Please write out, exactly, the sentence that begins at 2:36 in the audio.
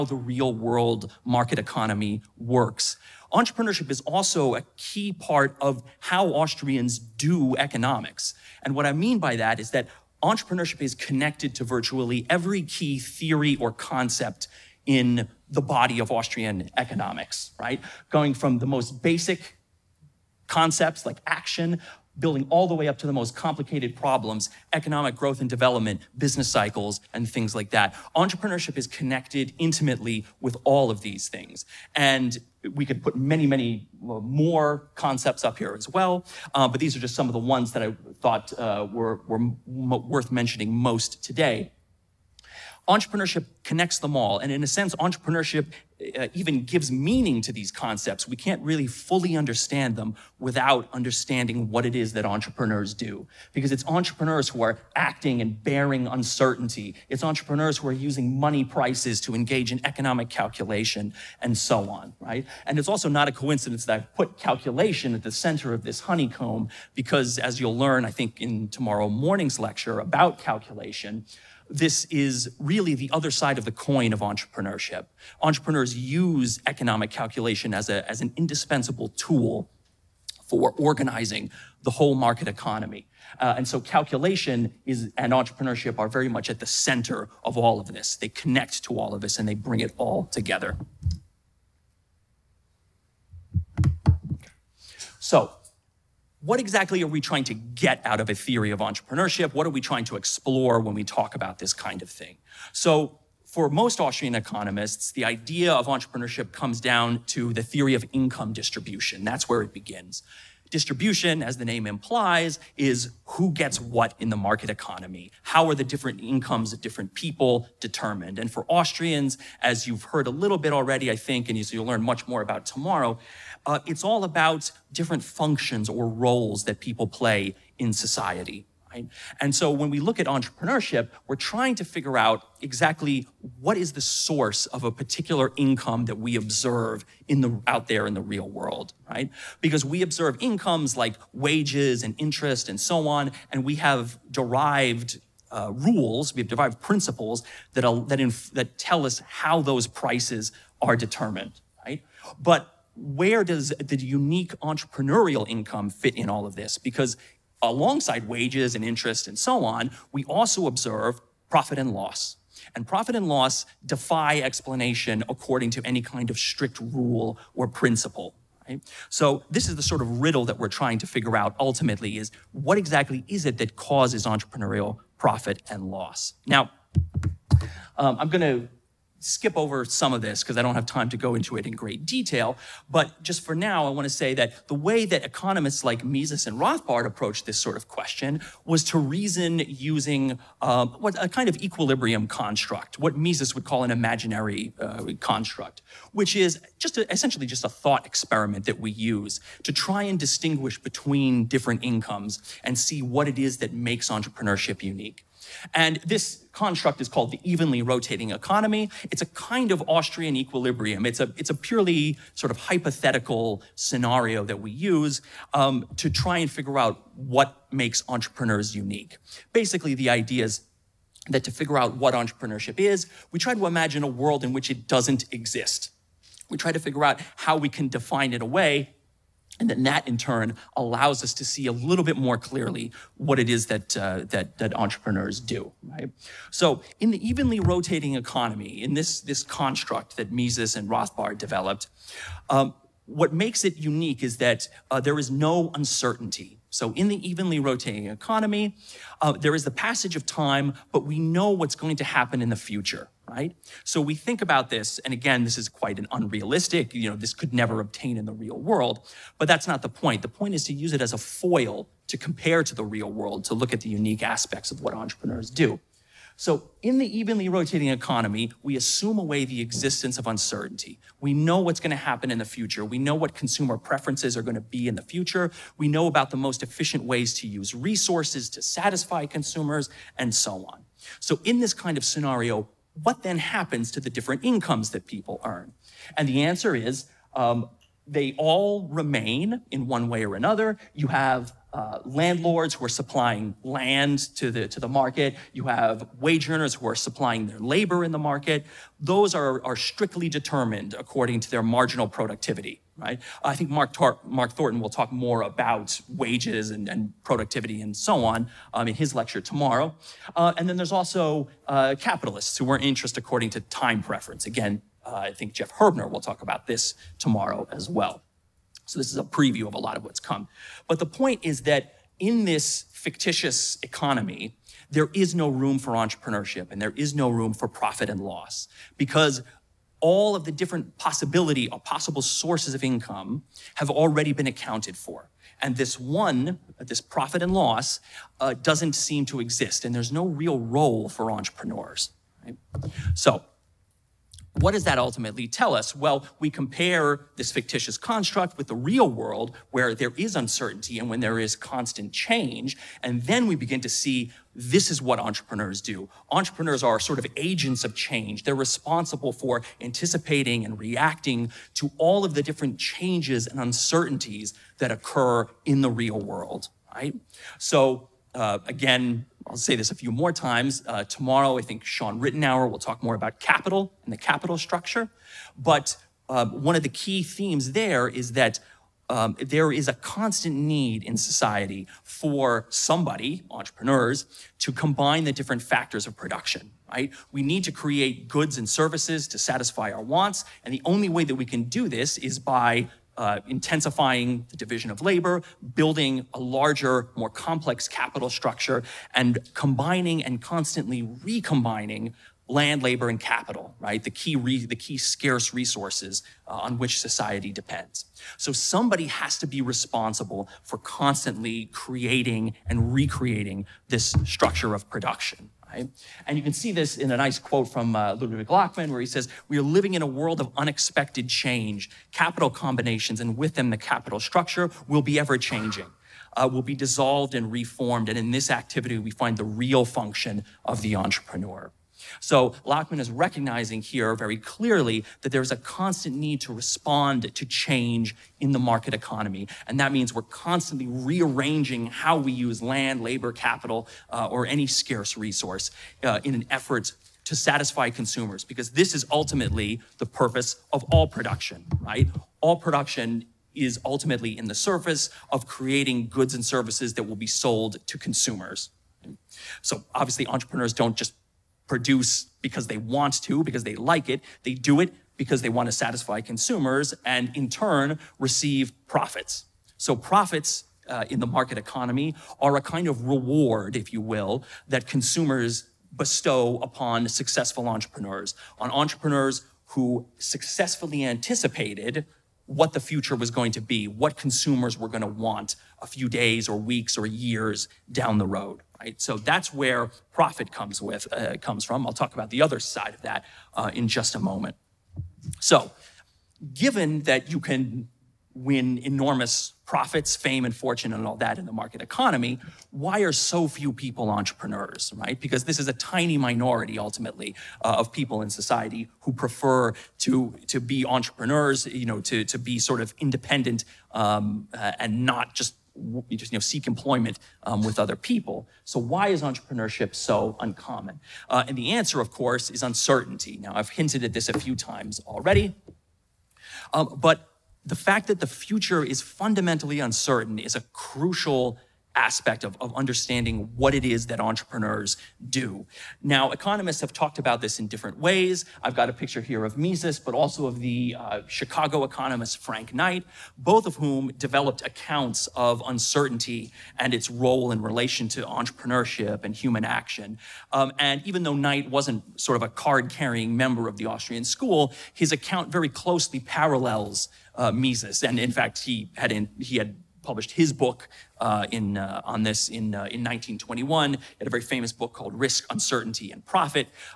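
Because alongside wages and interest and so on, we also observe profit and loss.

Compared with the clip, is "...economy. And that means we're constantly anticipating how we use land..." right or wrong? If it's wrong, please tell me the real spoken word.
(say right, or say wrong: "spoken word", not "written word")
wrong: "rearranging", not "anticipating".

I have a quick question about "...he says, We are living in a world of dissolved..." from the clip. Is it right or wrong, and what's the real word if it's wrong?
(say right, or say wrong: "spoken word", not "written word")
wrong: "unexpected", not "dissolved".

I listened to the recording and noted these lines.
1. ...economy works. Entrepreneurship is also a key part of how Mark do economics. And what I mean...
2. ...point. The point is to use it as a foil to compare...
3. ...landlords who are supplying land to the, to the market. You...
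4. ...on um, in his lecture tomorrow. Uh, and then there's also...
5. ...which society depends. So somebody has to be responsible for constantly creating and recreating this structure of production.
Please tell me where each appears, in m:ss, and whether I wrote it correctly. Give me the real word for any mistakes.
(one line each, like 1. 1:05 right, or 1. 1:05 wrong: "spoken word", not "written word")
1. 0:01 wrong: "Austrians", not "Mark"
2. 4:19 right
3. 4:52 right
4. 5:08 right
5. 6:46 right.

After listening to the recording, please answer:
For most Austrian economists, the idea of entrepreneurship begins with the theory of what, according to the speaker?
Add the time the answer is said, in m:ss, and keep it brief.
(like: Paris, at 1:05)
Income distribution, at 1:47.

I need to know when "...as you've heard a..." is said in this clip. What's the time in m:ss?
1:59.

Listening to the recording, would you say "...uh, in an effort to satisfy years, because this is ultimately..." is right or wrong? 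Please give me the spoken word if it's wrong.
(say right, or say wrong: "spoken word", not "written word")
wrong: "consumers", not "years".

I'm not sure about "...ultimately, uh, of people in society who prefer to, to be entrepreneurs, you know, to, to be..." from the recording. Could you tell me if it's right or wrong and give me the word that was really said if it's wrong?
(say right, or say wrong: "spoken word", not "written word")
right.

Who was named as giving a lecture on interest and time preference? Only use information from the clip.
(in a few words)
Jeff Herbener.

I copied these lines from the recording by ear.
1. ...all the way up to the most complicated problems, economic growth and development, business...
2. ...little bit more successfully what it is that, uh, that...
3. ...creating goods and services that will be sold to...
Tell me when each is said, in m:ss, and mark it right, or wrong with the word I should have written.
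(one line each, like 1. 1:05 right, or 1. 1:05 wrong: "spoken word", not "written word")
1. 0:22 right
2. 3:51 wrong: "clearly", not "successfully"
3. 7:35 right.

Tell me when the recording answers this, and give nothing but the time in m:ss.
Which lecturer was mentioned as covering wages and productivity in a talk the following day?
5:04.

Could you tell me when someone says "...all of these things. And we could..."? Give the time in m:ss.
0:30.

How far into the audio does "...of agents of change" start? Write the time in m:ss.
5:57.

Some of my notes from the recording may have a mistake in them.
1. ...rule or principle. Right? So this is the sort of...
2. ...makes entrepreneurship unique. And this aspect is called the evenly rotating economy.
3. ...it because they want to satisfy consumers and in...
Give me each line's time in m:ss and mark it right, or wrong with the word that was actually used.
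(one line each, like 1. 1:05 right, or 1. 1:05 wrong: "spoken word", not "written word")
1. 2:46 right
2. 3:23 wrong: "construct", not "aspect"
3. 7:44 right.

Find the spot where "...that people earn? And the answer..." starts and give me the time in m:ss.
4:44.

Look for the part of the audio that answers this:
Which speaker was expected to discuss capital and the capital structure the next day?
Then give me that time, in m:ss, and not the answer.
6:11.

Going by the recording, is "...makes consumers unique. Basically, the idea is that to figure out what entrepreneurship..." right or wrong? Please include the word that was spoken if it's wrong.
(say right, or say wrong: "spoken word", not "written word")
wrong: "entrepreneurs", not "consumers".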